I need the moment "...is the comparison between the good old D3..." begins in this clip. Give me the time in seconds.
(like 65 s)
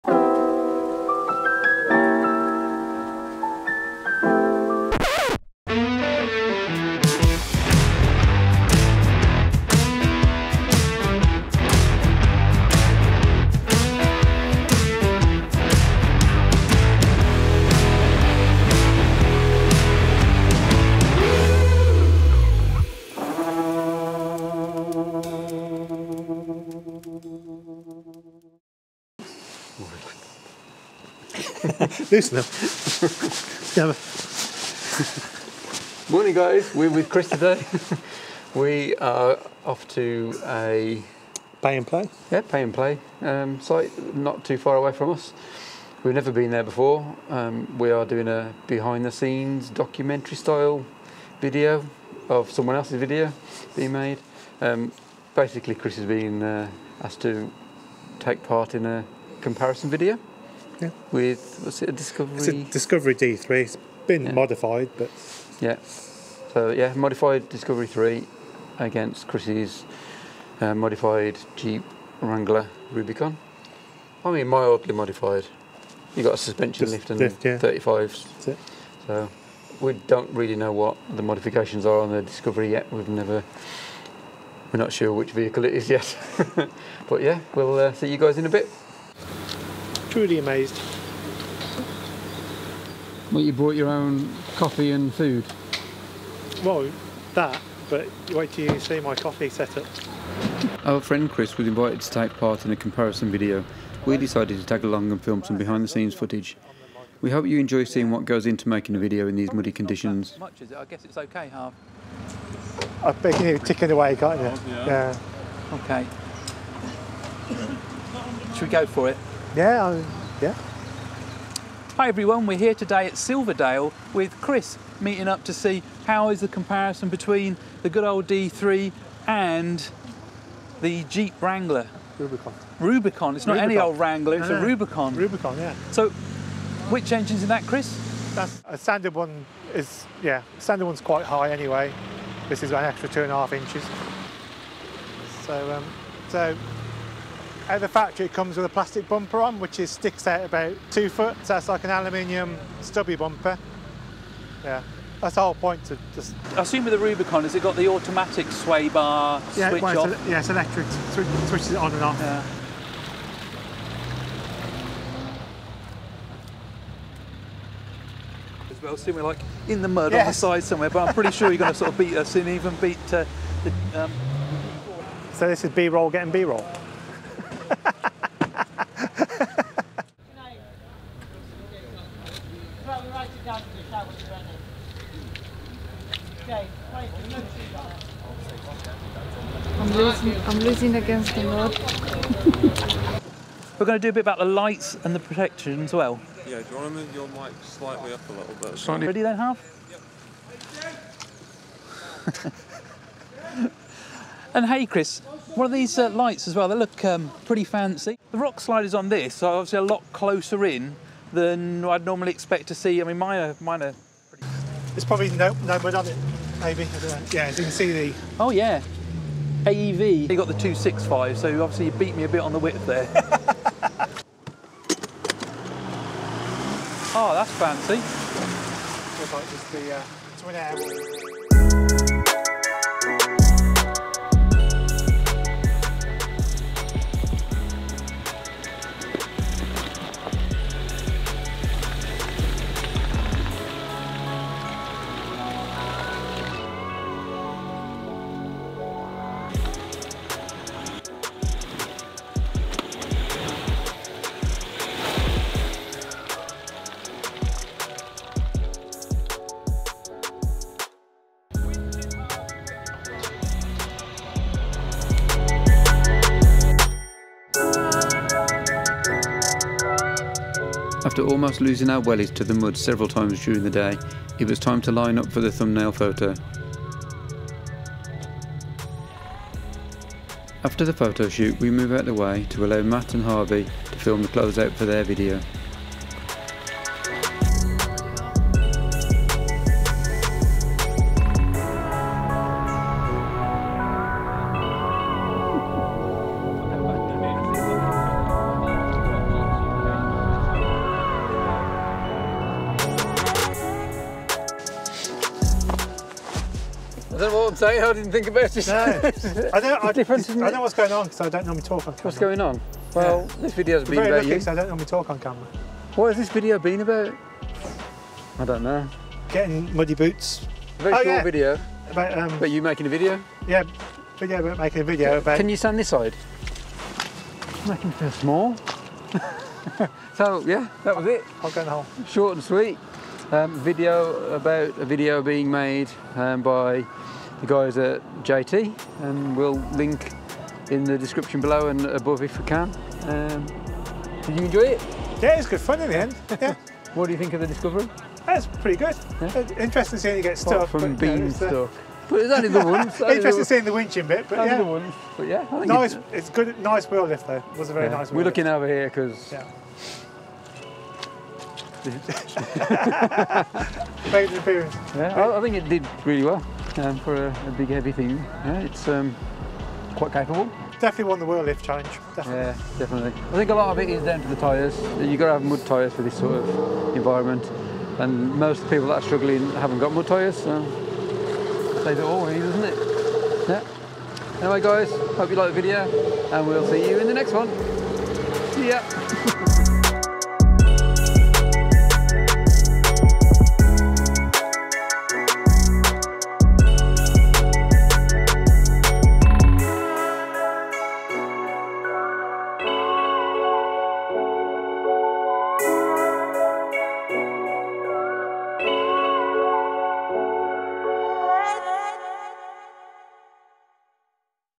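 126 s.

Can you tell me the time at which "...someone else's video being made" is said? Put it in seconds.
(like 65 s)
52 s.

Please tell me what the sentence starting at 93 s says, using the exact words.
Well, you brought your own coffee and food?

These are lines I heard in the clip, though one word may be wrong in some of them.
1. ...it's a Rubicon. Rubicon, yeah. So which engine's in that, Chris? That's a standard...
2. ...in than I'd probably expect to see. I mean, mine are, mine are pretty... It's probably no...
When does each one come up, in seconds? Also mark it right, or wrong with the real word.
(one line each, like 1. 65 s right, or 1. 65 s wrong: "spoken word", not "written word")
1. 134 s right
2. 210 s wrong: "normally", not "probably".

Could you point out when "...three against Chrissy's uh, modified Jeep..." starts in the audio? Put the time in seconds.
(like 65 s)
67 s.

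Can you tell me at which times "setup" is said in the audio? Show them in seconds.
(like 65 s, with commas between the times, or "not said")
99 s.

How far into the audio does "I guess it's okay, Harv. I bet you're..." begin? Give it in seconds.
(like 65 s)
110 s.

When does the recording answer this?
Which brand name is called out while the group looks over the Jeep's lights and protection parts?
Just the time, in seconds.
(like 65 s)
219 s.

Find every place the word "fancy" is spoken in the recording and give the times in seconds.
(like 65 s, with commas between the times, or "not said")
207 s, 227 s.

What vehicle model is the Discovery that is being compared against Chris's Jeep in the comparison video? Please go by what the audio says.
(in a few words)
Discovery D3.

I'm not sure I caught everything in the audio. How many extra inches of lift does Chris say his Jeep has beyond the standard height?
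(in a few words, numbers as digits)
2.5 inches.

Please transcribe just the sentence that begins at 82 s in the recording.
We've never we're not sure which vehicle it is yet.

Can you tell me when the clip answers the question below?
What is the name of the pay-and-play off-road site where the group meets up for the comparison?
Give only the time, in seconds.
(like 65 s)
123 s.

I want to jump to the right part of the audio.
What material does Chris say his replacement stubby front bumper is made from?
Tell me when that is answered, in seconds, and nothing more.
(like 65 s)
151 s.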